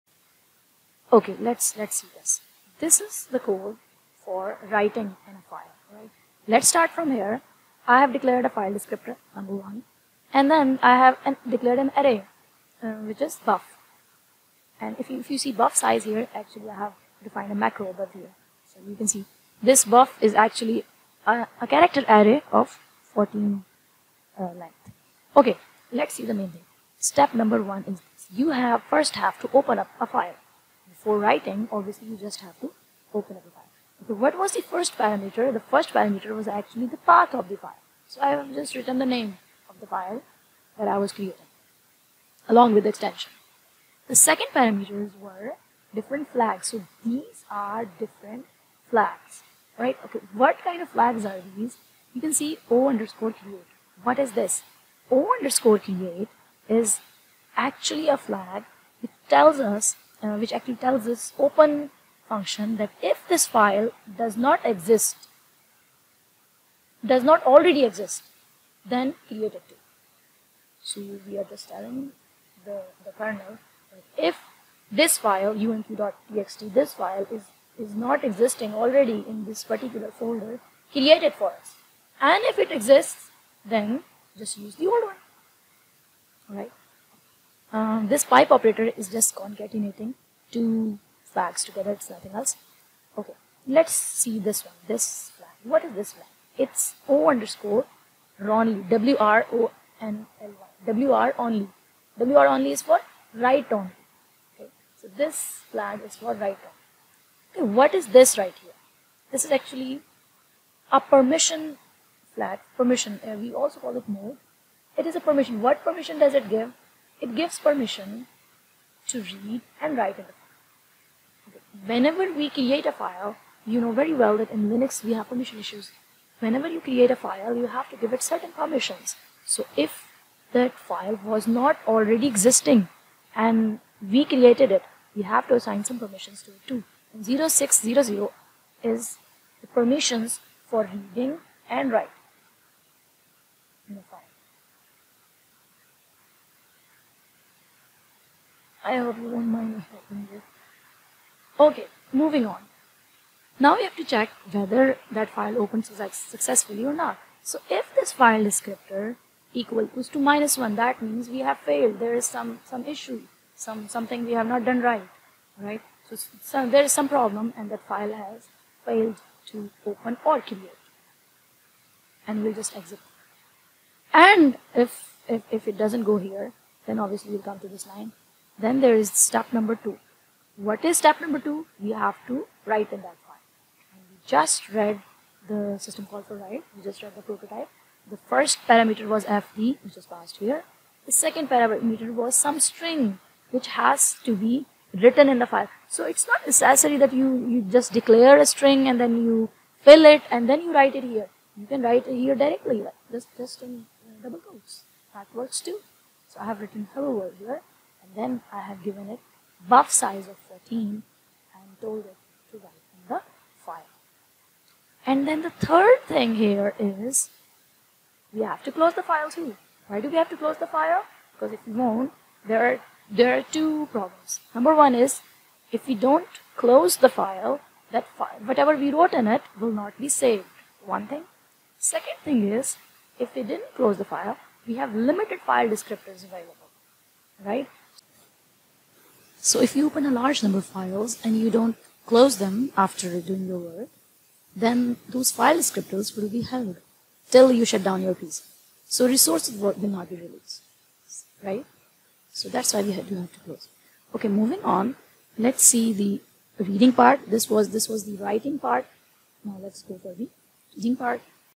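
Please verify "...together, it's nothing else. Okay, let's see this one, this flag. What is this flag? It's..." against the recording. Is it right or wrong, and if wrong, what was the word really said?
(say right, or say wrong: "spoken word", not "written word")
right.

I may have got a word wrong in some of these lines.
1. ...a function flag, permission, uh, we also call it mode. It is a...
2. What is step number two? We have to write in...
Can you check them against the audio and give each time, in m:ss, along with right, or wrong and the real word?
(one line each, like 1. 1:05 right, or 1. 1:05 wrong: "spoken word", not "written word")
1. 1:50 wrong: "permission", not "function"
2. 3:00 right.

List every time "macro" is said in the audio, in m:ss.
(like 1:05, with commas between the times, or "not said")
0:17.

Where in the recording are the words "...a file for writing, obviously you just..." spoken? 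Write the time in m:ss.
0:29.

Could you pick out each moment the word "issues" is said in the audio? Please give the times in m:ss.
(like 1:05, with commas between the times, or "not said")
2:05, 2:42.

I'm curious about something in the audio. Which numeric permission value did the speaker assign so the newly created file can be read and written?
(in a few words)
0600.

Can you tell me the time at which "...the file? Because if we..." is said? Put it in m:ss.
3:40.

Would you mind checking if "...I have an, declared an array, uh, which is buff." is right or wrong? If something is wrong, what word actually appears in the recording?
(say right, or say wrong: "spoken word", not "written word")
right.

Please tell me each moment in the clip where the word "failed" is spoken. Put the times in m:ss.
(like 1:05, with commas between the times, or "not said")
2:41, 2:48.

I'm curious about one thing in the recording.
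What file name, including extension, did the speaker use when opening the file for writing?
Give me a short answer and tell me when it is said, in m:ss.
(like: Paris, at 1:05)
umq.txt, at 1:15.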